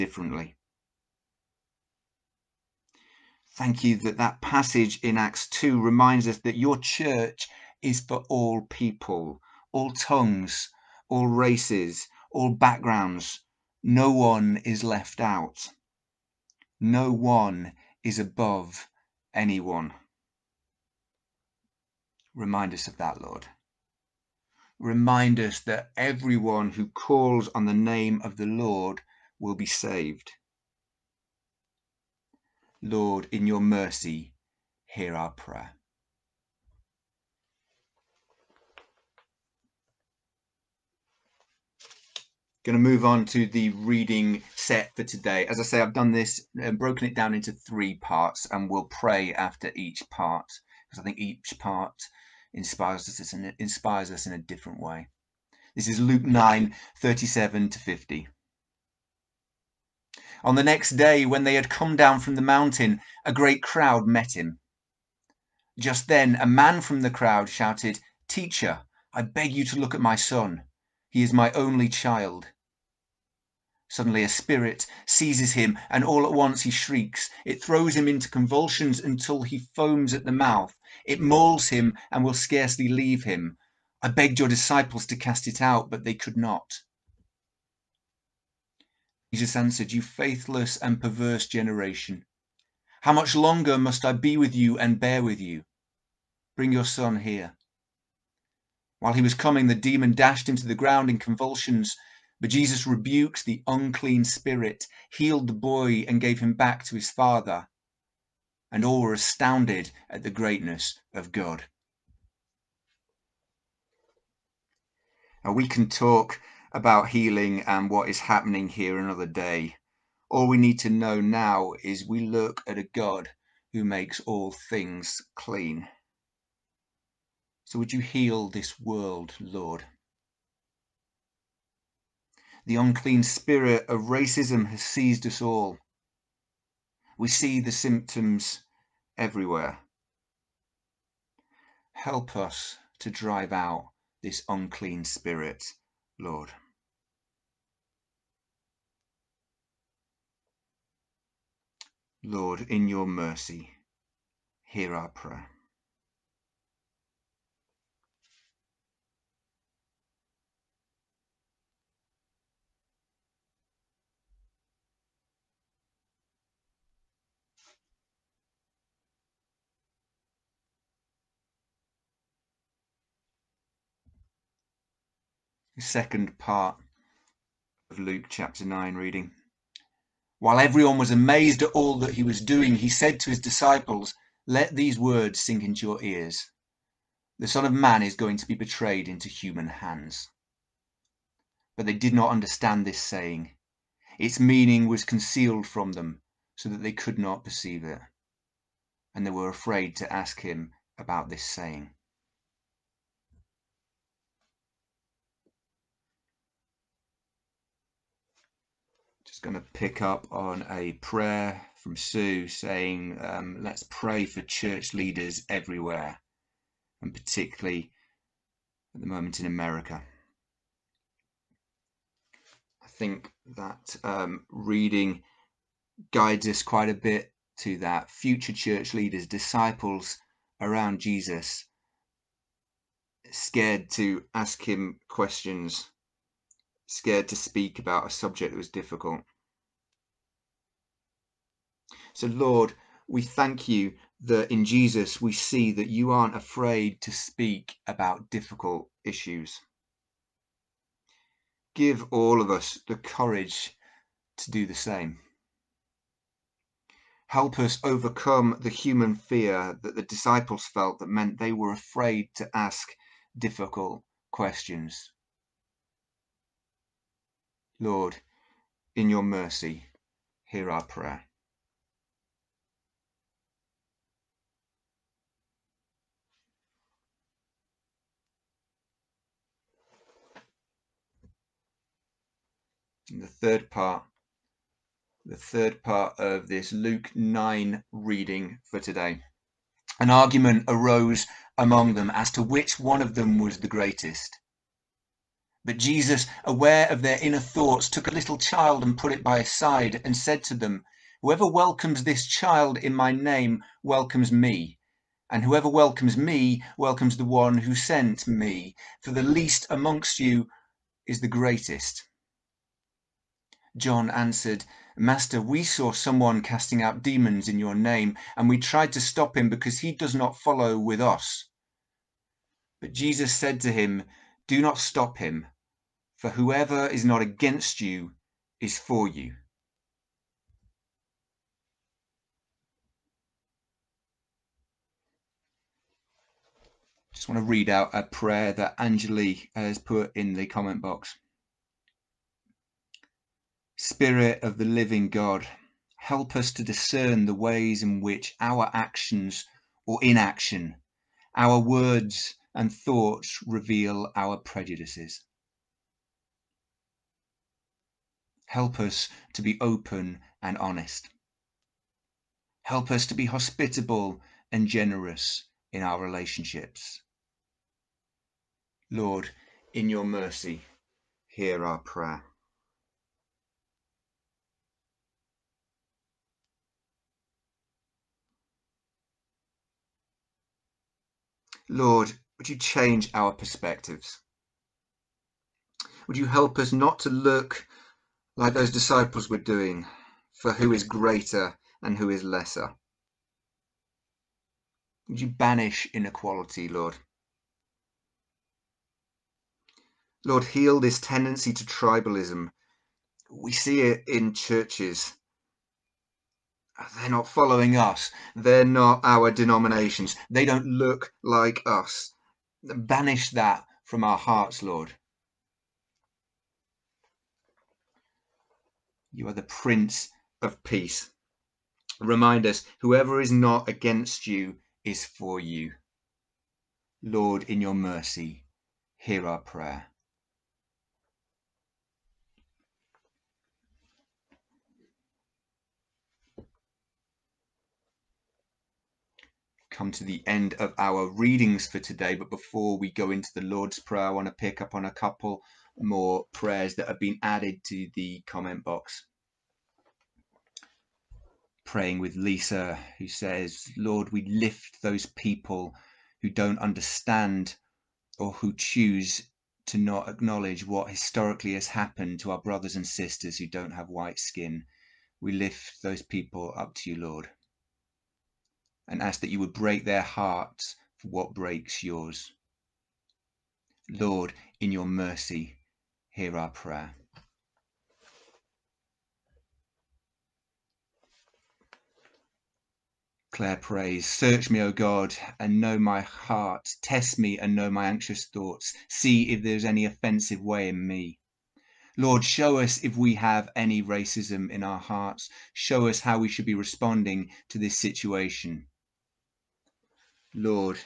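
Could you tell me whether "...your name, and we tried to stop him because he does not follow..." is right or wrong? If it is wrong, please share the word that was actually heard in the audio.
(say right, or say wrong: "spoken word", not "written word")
right.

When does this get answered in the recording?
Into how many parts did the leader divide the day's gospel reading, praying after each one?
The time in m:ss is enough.
0:47.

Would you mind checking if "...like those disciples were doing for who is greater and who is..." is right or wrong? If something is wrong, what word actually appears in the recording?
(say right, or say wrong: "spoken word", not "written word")
right.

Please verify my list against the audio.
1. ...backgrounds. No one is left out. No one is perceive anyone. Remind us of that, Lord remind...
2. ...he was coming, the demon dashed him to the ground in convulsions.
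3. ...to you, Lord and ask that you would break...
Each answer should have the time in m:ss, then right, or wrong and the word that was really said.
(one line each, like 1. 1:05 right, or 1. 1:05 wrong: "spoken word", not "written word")
1. 0:12 wrong: "above", not "perceive"
2. 1:39 right
3. 7:46 right.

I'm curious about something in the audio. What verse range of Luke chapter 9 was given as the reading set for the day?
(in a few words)
37 to 50.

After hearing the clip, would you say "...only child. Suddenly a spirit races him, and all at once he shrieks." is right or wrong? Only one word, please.
wrong.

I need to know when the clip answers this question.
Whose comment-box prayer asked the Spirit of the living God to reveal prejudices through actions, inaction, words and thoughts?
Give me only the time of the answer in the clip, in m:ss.
5:38.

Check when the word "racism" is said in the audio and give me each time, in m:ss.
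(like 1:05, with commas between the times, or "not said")
2:14, 8:13.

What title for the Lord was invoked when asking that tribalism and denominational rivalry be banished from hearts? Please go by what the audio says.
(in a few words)
Prince of Peace.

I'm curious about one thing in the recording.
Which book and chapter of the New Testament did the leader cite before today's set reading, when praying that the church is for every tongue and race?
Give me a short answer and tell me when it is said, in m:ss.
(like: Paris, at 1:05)
Acts 2, at 0:05.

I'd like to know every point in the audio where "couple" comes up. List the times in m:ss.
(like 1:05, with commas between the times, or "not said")
7:24.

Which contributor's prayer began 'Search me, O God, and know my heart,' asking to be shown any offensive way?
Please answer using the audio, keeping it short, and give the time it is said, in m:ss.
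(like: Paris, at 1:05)
Claire, at 8:03.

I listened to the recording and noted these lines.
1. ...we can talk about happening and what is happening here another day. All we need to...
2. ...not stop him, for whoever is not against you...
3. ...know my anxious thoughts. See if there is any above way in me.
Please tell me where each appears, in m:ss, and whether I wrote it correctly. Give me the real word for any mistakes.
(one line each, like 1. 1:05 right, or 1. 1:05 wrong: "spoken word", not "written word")
1. 1:55 wrong: "healing", not "happening"
2. 5:24 right
3. 8:07 wrong: "offensive", not "above".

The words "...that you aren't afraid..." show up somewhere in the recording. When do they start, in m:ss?
4:05.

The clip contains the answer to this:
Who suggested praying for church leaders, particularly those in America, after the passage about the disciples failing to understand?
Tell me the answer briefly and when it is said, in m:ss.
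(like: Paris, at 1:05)
Sue, at 3:31.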